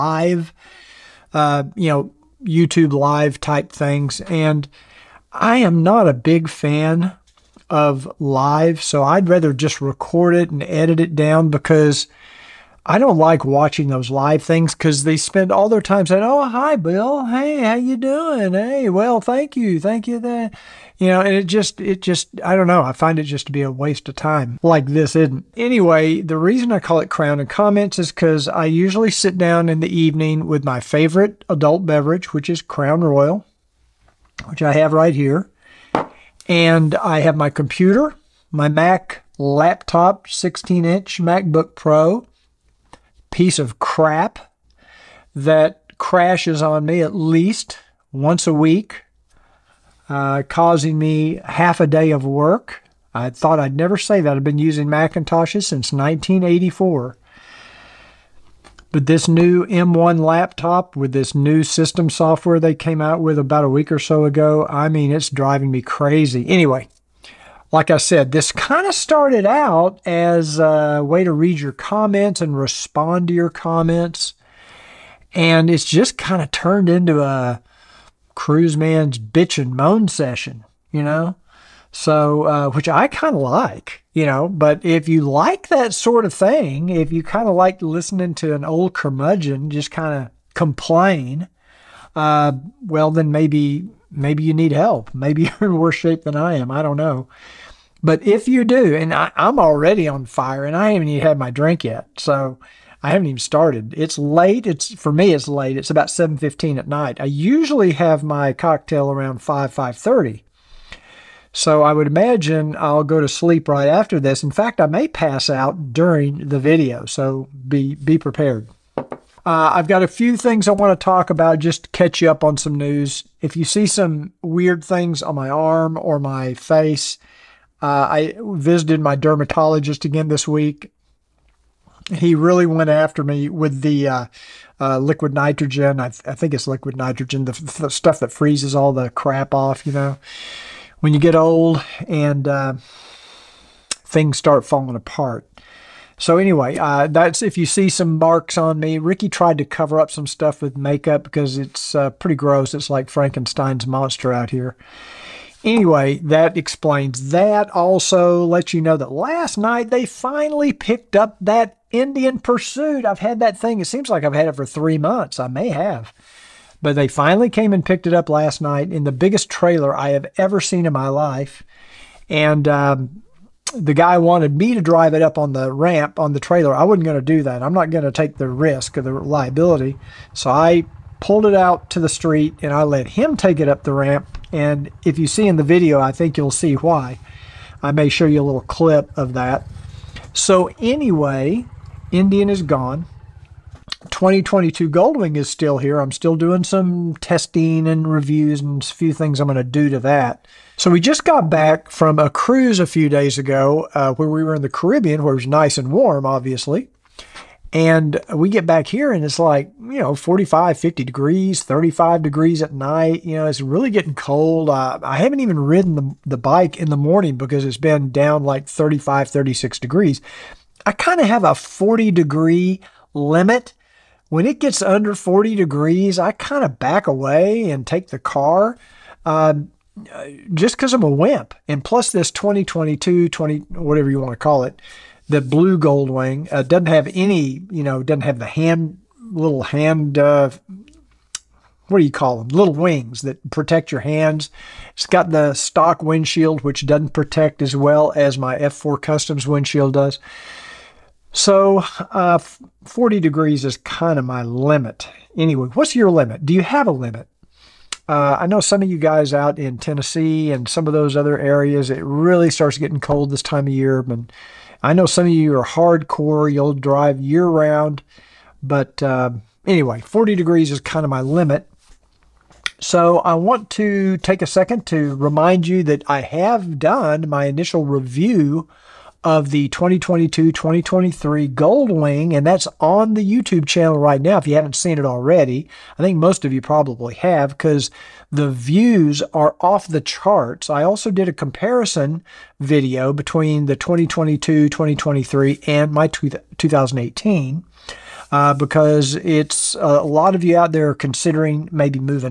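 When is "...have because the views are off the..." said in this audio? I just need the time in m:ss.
4:47.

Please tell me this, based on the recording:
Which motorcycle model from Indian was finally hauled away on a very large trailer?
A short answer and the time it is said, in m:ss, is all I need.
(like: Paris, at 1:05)
Pursuit, at 2:42.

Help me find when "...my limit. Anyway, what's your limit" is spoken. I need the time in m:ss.
4:14.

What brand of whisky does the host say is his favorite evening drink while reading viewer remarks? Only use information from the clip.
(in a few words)
Crown Royal.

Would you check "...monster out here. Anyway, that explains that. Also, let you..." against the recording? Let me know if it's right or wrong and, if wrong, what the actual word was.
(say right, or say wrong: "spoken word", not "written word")
right.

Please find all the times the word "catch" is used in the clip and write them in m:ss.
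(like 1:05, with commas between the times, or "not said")
2:01.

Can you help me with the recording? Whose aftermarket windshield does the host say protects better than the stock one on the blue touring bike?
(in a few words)
F4 Customs.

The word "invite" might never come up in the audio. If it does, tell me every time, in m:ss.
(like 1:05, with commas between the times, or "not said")
not said.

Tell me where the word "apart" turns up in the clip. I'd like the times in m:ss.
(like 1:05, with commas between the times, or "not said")
2:24.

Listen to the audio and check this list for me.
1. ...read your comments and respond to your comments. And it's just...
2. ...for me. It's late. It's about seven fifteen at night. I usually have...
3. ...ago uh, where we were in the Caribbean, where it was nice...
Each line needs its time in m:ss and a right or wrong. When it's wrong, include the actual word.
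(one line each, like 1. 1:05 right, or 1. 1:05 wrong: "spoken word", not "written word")
1. 1:11 right
2. 1:44 right
3. 3:23 right.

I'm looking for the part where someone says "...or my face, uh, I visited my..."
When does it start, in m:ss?
2:06.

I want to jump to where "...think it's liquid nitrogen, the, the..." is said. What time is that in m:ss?
2:16.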